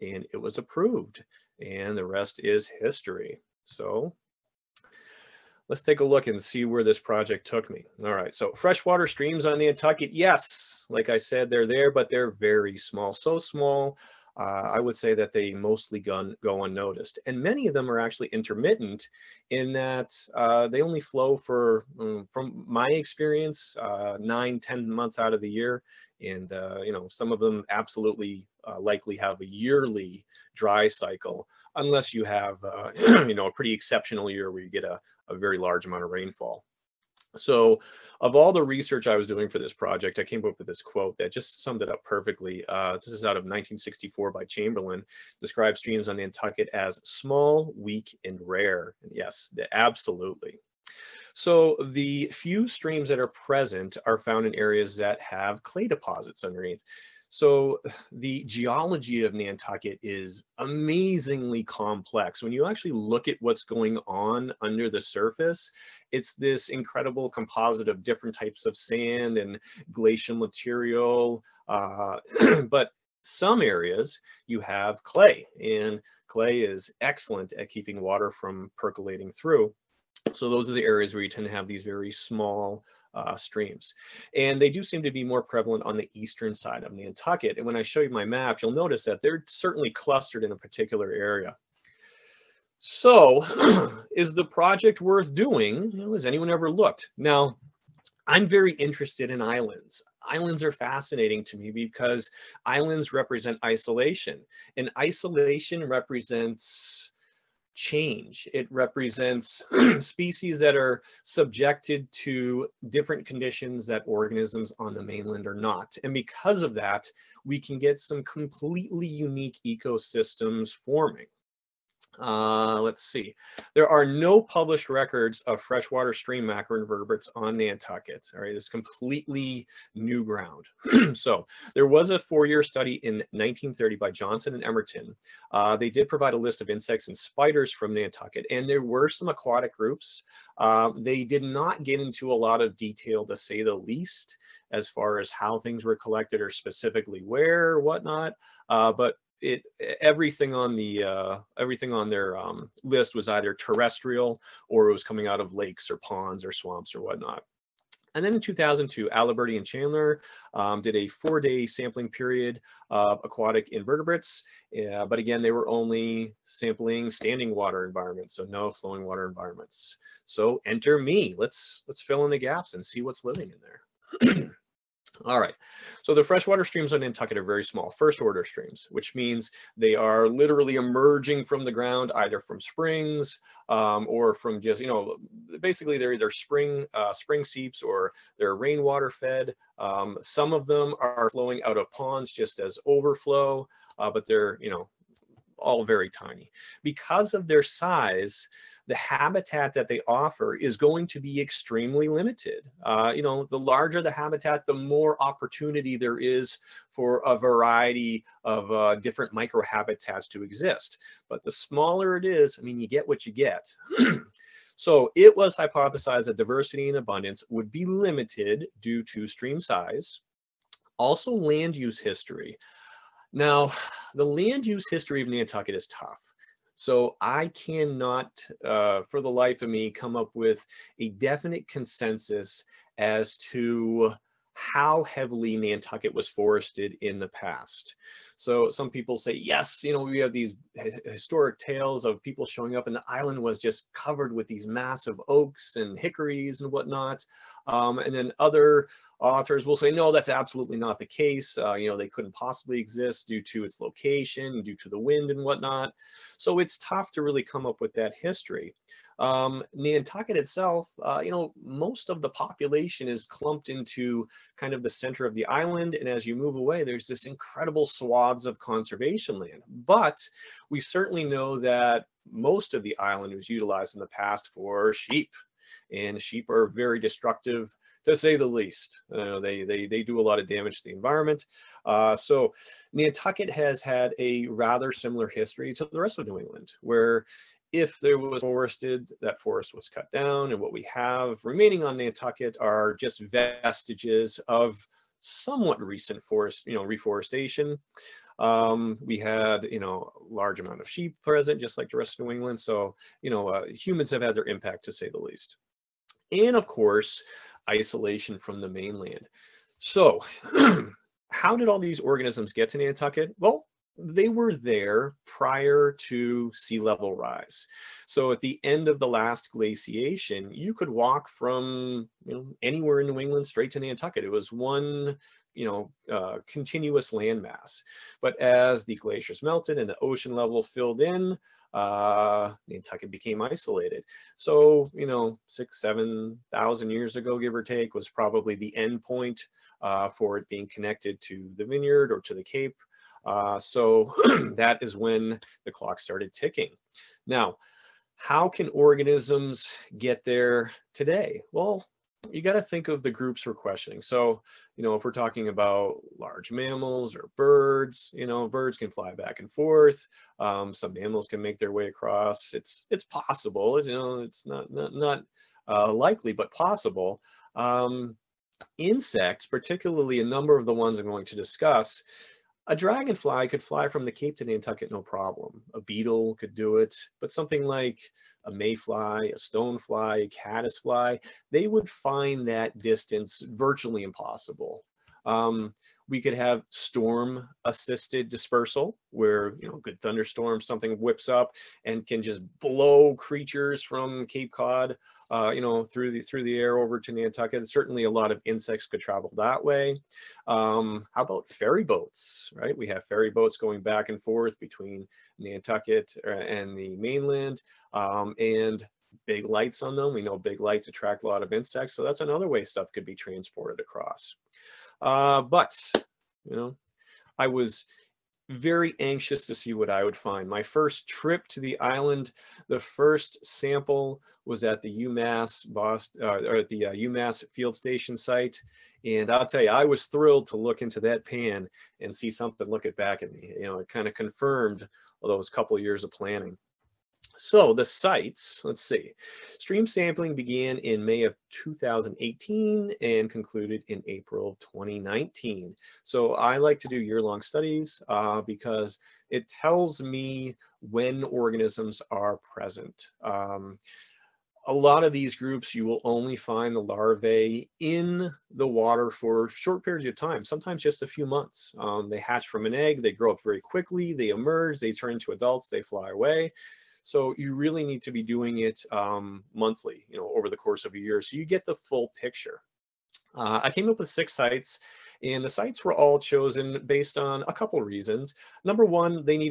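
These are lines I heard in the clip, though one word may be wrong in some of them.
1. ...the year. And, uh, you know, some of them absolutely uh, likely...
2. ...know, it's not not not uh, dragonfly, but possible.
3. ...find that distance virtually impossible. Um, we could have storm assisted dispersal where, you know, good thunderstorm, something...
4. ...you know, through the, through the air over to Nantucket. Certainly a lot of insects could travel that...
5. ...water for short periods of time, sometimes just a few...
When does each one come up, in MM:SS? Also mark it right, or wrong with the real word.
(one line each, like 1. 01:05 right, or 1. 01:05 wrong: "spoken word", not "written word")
1. 00:25 right
2. 06:03 wrong: "likely", not "dragonfly"
3. 06:21 right
4. 06:35 right
5. 07:38 right.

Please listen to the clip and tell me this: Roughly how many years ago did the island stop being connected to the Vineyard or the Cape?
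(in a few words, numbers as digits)
6,000 to 7,000 years.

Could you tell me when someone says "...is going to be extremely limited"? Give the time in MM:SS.
03:20.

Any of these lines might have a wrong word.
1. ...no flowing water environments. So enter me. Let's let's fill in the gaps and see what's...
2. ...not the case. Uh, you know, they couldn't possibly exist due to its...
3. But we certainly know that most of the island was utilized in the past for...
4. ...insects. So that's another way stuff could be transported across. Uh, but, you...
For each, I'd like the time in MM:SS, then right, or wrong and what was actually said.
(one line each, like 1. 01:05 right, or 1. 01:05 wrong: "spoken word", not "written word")
1. 02:48 right
2. 04:10 right
3. 04:29 right
4. 06:51 right.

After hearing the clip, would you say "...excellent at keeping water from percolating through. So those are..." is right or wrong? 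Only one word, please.
right.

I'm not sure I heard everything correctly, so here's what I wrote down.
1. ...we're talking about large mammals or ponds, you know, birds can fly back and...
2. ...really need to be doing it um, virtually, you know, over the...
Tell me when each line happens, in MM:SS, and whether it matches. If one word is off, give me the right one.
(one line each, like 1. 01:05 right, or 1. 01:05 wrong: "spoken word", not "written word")
1. 05:55 wrong: "birds", not "ponds"
2. 07:47 wrong: "monthly", not "virtually".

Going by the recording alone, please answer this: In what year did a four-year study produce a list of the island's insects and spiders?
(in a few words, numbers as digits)
1930.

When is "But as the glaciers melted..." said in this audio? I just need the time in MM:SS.
05:28.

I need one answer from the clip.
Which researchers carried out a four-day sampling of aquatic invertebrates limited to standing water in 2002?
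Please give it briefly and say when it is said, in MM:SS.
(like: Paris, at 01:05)
Aliberti and Chandler, at 02:39.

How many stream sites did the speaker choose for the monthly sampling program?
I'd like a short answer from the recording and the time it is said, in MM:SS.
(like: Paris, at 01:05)
6, at 07:54.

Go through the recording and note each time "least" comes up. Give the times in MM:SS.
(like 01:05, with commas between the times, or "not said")
02:23, 04:38, 05:05.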